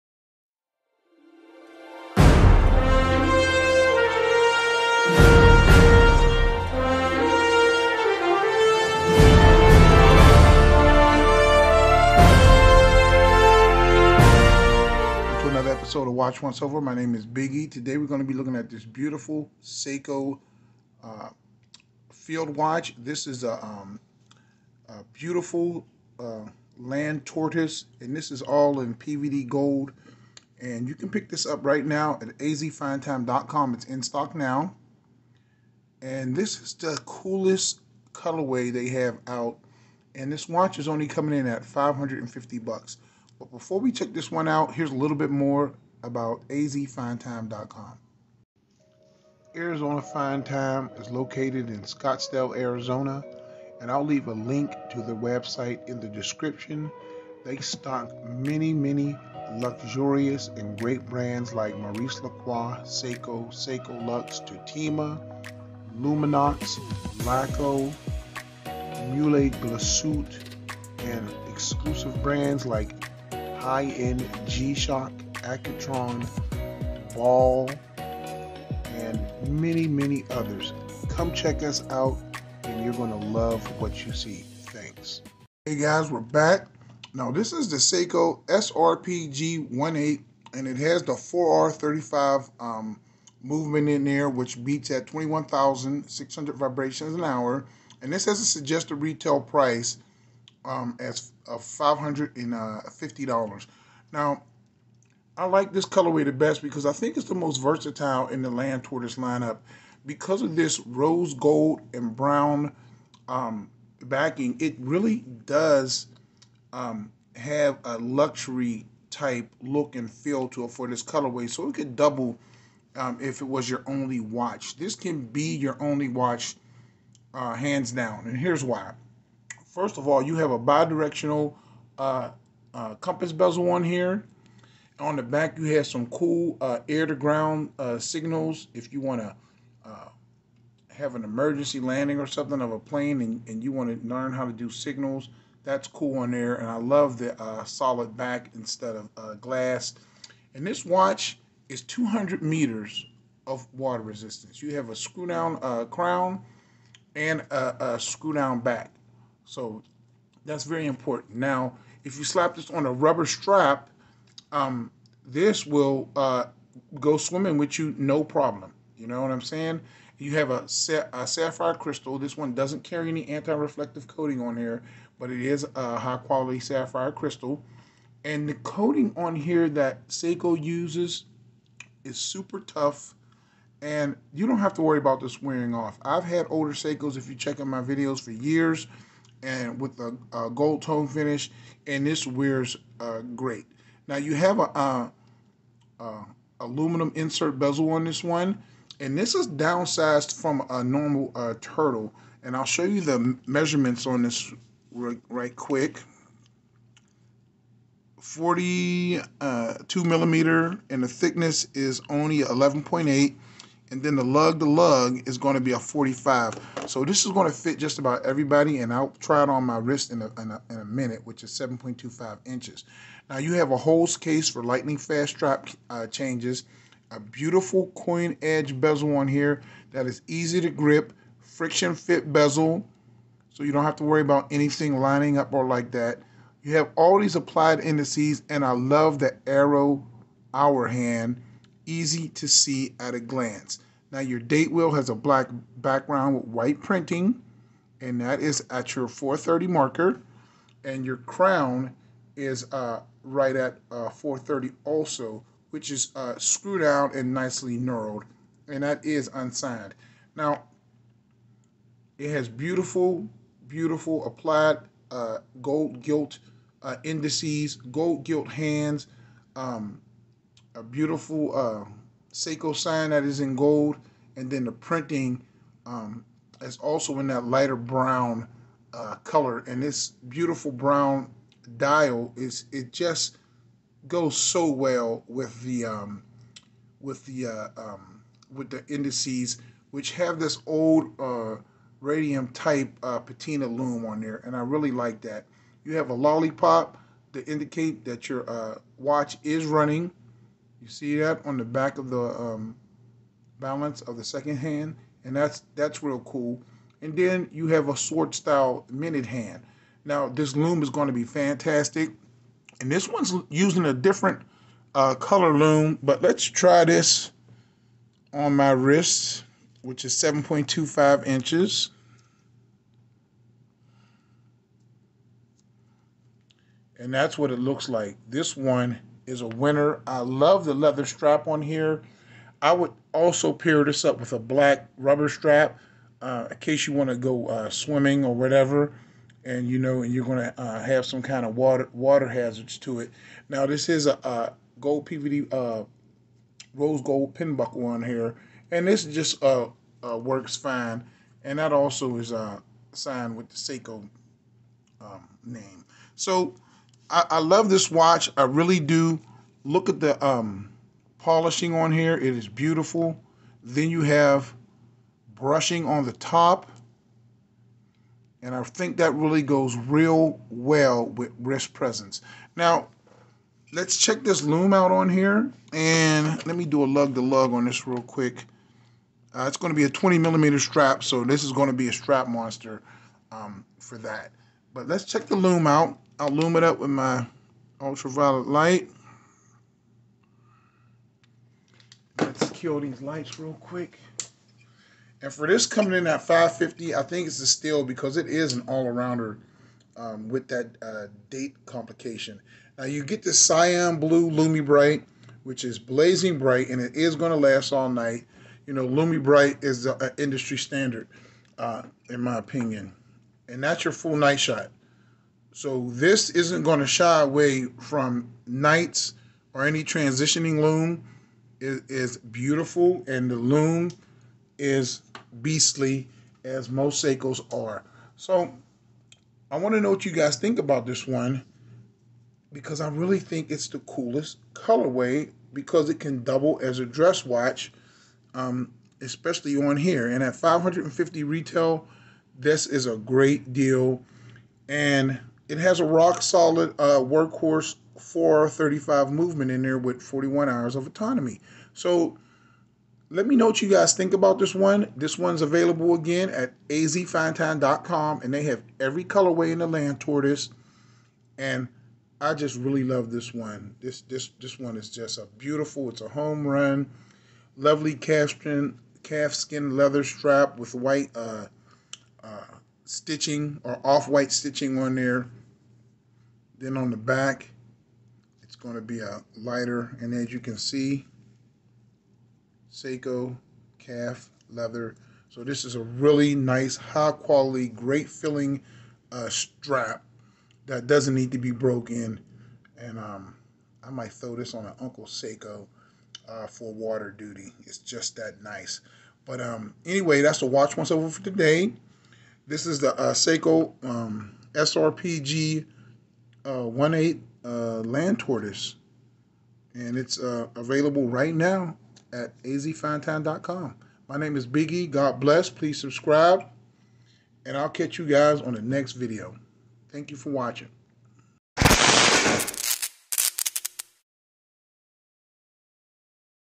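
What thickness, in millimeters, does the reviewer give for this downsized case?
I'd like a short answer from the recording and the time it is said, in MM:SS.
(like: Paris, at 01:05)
11.8, at 03:32.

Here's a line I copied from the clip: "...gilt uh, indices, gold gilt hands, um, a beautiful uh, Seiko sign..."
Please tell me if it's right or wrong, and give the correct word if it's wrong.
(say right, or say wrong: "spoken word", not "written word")
right.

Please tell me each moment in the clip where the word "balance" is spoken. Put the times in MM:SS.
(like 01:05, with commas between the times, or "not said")
05:03.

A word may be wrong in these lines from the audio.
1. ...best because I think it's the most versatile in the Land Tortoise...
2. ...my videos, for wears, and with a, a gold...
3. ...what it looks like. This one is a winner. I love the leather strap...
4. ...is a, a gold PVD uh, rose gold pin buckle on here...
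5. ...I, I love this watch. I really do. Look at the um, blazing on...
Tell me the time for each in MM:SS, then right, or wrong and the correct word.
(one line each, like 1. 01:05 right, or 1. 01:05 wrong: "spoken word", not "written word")
1. 01:46 right
2. 03:07 wrong: "years", not "wears"
3. 05:27 right
4. 05:43 right
5. 05:57 wrong: "polishing", not "blazing".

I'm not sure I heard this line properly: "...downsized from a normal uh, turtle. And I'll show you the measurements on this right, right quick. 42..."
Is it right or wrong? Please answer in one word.
right.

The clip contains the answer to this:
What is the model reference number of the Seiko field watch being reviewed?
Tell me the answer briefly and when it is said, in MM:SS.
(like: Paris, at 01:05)
SRPG18, at 01:28.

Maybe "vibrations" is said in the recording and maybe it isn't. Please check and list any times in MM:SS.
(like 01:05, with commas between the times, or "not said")
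01:36.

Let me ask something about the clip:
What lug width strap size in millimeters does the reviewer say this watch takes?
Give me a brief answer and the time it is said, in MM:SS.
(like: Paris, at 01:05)
20 millimeter, at 06:19.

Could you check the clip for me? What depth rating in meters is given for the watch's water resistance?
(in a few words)
200 meters.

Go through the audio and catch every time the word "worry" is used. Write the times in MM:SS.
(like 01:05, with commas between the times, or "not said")
03:04, 03:54.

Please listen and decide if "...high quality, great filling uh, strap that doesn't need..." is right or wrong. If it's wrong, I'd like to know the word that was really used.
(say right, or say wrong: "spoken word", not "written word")
right.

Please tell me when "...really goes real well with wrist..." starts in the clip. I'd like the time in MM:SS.
06:09.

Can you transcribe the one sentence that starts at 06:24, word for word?
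But let's check the loom out.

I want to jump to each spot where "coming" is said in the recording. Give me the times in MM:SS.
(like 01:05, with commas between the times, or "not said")
00:41, 06:35.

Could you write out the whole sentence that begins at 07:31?
So let me know what you guys think about this one.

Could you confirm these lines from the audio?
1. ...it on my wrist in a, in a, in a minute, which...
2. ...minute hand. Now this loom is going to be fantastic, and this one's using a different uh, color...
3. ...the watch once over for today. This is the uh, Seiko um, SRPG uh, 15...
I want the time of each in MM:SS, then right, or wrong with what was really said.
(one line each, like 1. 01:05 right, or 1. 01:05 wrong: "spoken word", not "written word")
1. 03:39 right
2. 05:08 right
3. 08:20 wrong: "18", not "15".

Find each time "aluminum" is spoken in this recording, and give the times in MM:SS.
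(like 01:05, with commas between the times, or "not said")
03:16.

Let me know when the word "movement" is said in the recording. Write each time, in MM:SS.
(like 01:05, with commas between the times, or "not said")
01:33, 07:29.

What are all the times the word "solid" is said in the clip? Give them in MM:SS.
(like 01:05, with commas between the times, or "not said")
02:27, 07:26.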